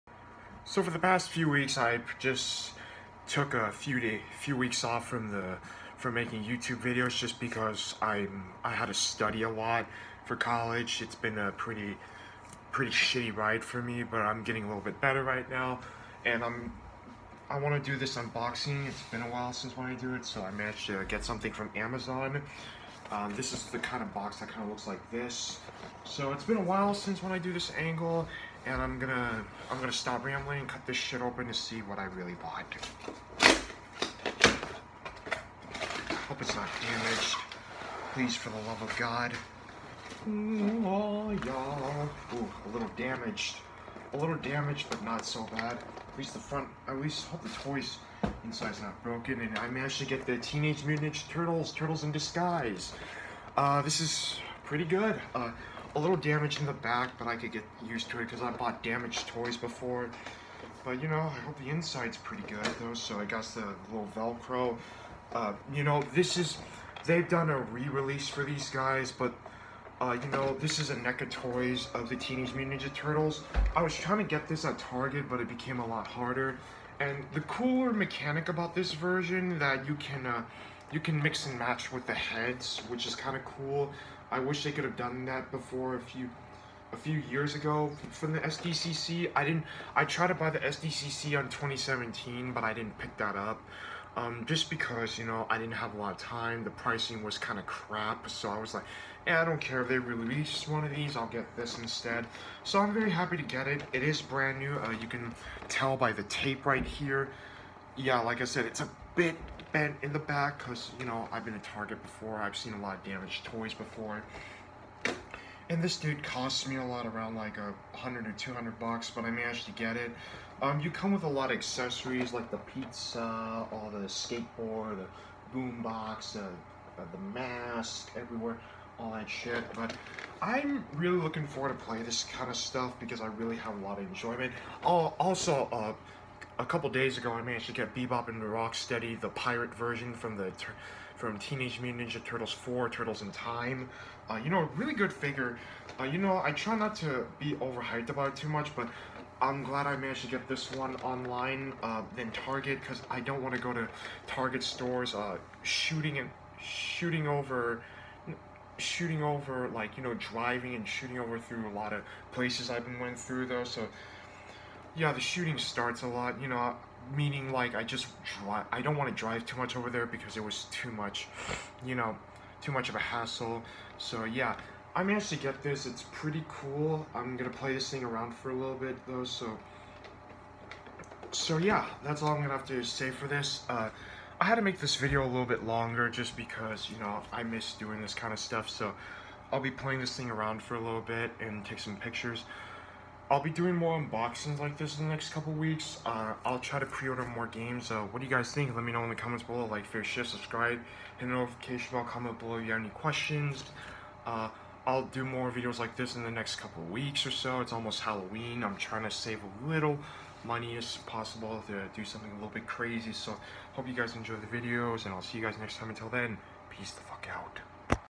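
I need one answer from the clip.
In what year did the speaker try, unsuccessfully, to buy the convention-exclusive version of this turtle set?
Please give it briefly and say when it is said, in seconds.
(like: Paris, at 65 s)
2017, at 91 s.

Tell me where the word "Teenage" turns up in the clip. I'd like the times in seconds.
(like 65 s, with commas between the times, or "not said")
50 s, 72 s, 141 s.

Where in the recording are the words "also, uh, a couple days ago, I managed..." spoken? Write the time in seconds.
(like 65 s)
134 s.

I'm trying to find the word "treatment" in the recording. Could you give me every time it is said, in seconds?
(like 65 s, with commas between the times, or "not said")
not said.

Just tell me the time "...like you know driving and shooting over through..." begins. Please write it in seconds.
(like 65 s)
159 s.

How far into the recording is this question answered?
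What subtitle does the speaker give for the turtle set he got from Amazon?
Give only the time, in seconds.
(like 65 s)
51 s.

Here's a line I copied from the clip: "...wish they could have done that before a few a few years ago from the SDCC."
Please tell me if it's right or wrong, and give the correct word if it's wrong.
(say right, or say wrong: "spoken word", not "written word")
right.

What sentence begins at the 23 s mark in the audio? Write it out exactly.
Um, this is the kind of box that kind of looks like this.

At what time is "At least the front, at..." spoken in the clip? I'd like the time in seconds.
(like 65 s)
46 s.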